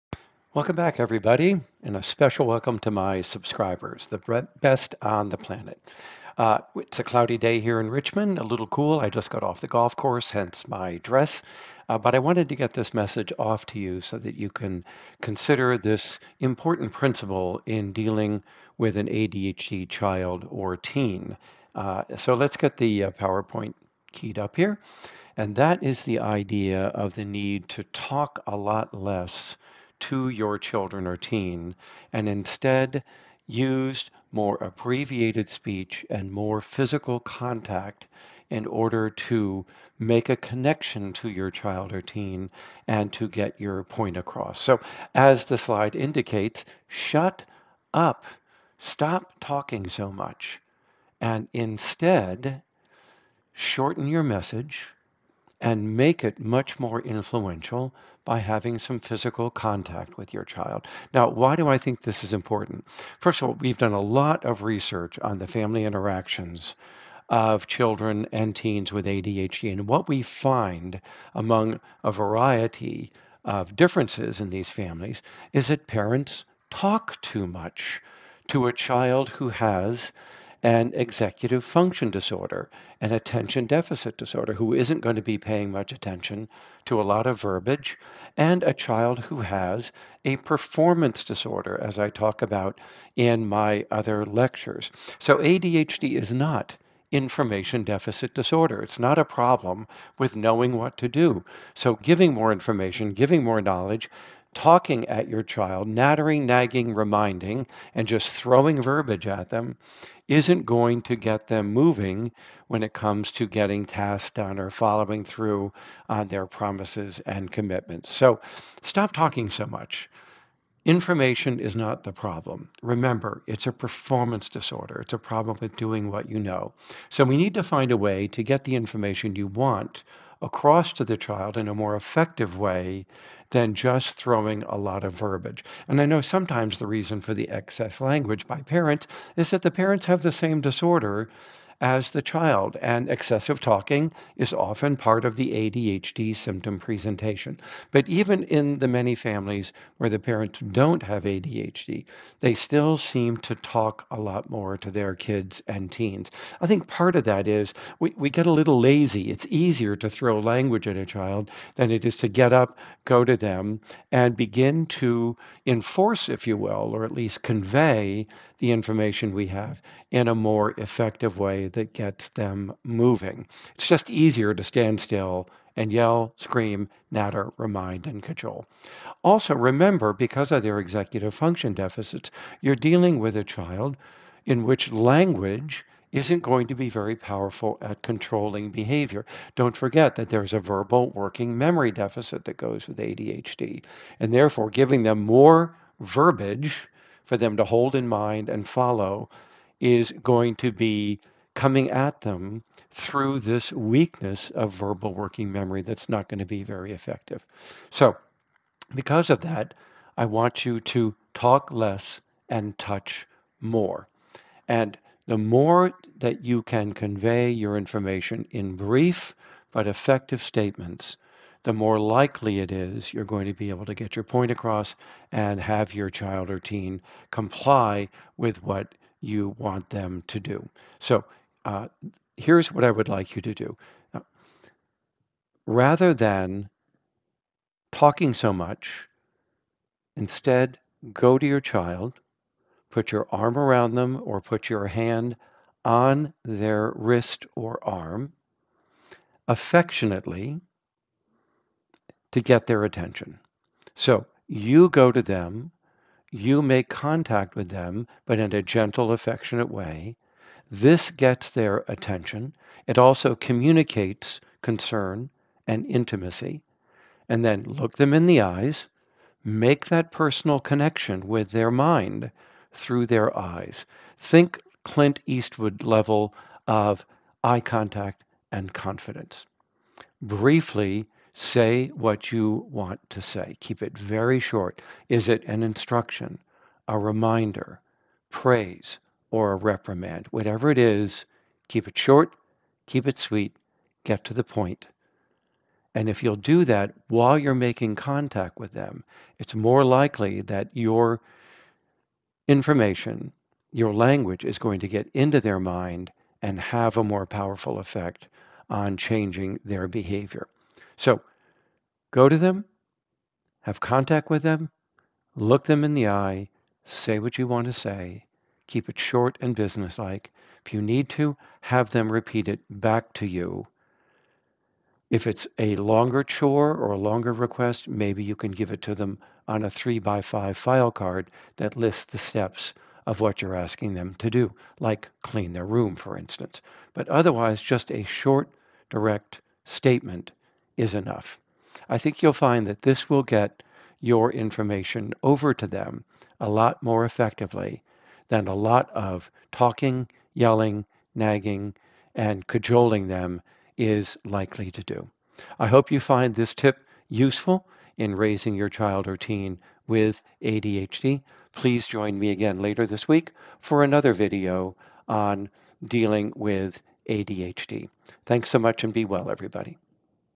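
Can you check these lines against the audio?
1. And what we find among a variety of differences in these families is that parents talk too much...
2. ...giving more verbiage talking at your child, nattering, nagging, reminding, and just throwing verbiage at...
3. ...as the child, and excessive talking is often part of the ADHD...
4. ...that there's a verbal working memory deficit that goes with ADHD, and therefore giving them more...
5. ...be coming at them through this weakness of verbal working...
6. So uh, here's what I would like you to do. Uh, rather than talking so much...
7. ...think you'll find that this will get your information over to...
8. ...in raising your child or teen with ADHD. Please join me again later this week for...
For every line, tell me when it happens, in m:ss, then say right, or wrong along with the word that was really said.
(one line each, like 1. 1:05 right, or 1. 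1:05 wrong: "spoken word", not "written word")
1. 1:09 right
2. 1:43 wrong: "knowledge", not "verbiage"
3. 2:21 right
4. 3:10 right
5. 3:20 right
6. 3:50 right
7. 5:41 right
8. 5:57 right.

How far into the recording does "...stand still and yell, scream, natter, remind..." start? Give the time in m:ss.
2:54.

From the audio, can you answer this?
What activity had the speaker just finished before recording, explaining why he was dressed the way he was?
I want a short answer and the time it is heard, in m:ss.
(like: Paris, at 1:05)
Golf, at 0:09.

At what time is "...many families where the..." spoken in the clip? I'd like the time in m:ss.
2:28.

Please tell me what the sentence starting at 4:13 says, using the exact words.
So you go to them, you make contact with them, but in a gentle, affectionate way.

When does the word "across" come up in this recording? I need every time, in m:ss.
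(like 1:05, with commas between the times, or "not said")
0:44, 2:10, 3:44.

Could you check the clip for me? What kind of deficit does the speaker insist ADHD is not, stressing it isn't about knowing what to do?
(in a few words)
Information deficit.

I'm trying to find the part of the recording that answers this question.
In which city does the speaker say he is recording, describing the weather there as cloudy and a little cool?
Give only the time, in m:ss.
0:07.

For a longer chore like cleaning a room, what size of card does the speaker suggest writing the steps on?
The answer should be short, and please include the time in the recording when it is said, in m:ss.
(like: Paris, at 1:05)
3 by 5, at 5:29.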